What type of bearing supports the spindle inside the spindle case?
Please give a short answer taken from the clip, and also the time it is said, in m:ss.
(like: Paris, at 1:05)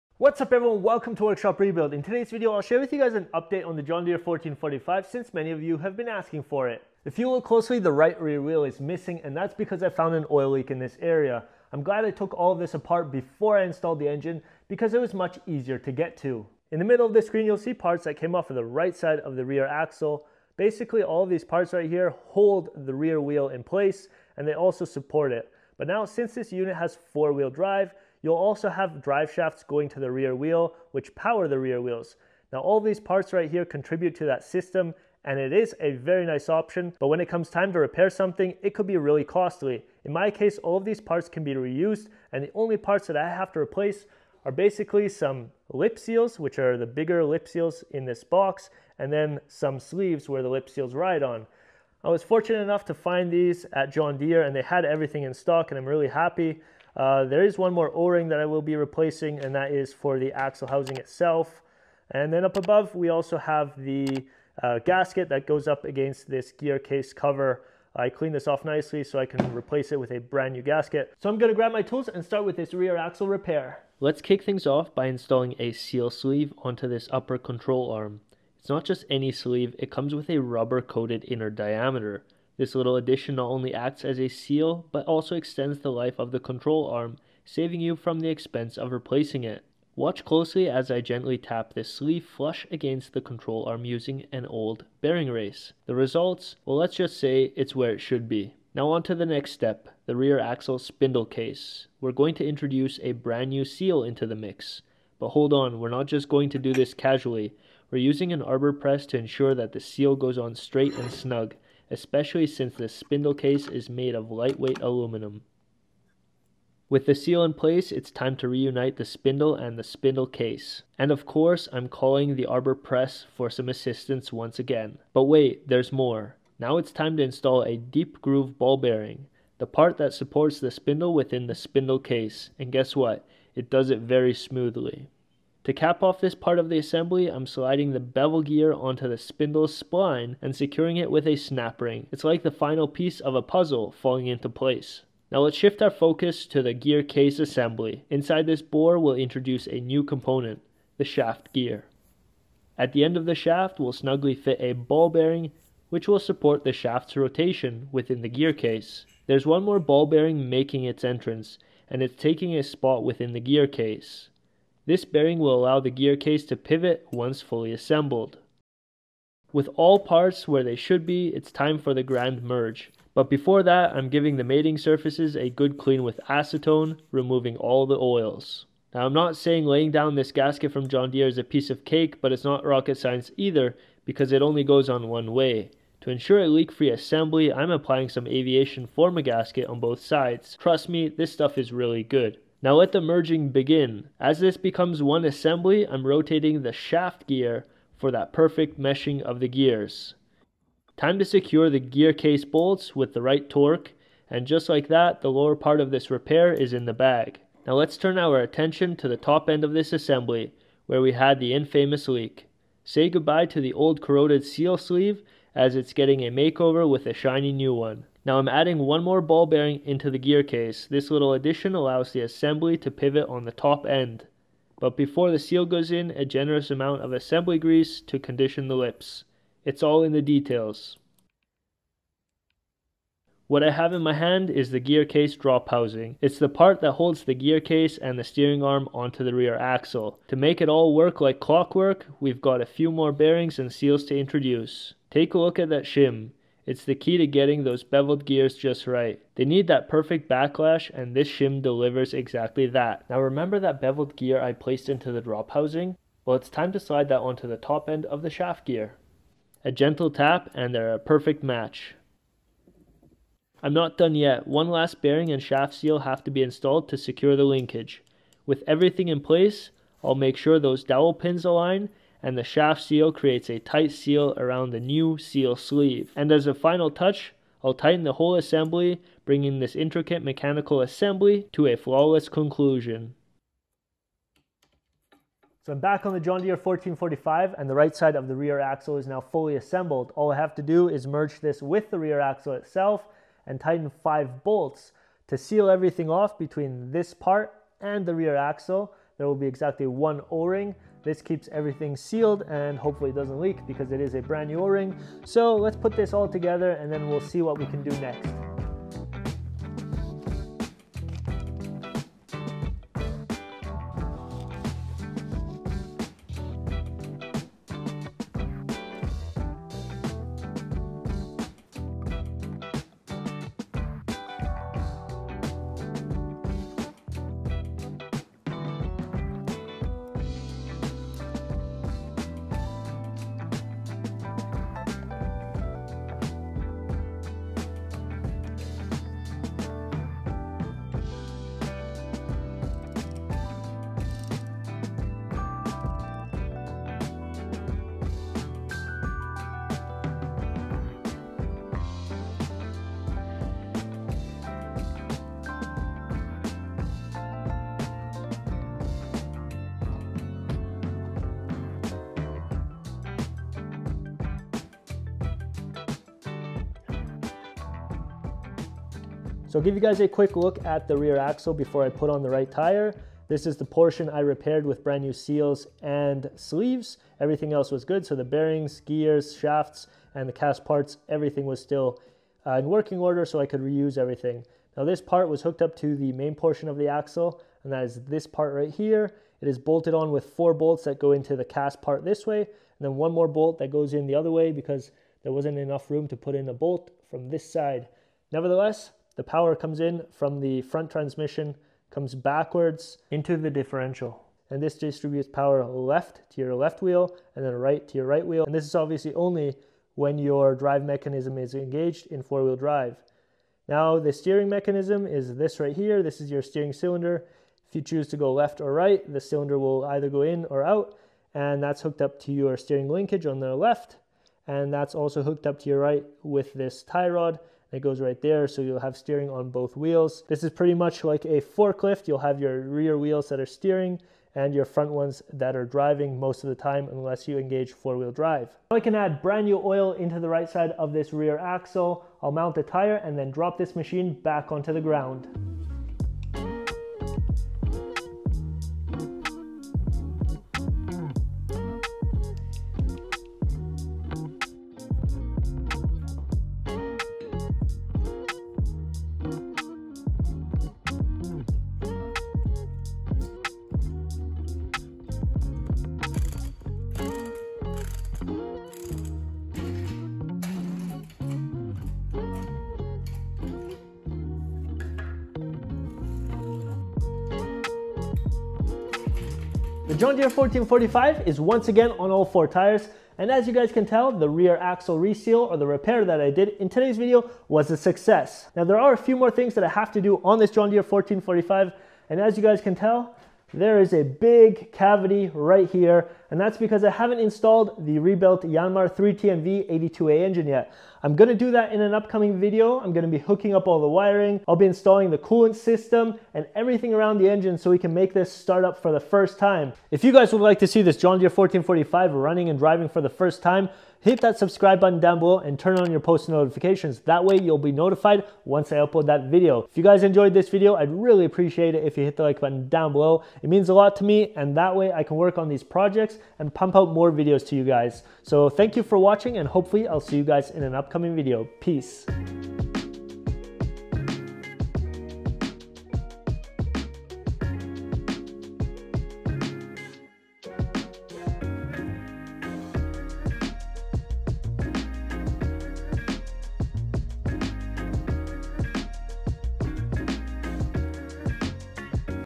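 deep groove ball bearing, at 2:07.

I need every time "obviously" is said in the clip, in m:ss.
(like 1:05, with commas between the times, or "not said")
6:48.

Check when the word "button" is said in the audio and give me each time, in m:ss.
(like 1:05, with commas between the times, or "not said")
8:34, 8:42.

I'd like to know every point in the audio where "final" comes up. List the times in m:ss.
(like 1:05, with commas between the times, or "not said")
2:22, 4:36.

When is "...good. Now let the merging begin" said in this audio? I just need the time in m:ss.
3:12.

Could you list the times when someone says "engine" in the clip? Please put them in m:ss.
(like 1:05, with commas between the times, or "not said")
0:14, 8:20, 8:27.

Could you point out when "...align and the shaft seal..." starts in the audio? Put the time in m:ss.
4:31.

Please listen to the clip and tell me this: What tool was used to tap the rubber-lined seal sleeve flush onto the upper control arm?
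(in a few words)
an old bearing race.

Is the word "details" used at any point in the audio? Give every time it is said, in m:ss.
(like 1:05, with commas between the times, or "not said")
3:50.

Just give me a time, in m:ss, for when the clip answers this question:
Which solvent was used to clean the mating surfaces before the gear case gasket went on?
2:56.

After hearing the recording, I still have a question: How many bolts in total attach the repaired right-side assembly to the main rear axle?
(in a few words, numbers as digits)
5.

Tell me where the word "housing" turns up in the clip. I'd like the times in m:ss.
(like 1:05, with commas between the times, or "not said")
1:00, 3:55, 4:15.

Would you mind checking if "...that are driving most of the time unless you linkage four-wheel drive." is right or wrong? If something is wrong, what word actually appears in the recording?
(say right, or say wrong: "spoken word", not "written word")
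wrong: "engage", not "linkage".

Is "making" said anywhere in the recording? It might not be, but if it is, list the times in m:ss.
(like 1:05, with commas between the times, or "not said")
2:40.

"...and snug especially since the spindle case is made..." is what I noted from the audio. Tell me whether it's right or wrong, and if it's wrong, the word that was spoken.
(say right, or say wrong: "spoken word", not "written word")
right.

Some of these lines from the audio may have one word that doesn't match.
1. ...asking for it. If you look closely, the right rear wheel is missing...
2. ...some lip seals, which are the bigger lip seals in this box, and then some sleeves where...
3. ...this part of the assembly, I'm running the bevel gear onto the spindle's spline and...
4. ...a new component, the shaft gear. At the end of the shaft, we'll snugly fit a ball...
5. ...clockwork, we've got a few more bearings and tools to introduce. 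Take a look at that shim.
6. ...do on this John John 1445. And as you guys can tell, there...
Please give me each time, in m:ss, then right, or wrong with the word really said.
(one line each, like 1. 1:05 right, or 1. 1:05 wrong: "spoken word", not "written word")
1. 0:06 right
2. 0:45 right
3. 2:16 wrong: "sliding", not "running"
4. 2:29 right
5. 4:01 wrong: "seals", not "tools"
6. 8:10 wrong: "Deere", not "John".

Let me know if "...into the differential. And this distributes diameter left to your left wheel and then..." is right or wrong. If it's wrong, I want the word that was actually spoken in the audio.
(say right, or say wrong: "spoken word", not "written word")
wrong: "power", not "diameter".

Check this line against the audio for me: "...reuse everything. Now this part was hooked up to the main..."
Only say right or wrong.
right.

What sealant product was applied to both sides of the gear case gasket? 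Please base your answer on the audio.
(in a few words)
aviation Form-A-Gasket.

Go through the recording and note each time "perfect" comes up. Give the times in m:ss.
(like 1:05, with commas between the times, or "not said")
3:18, 4:09, 4:20.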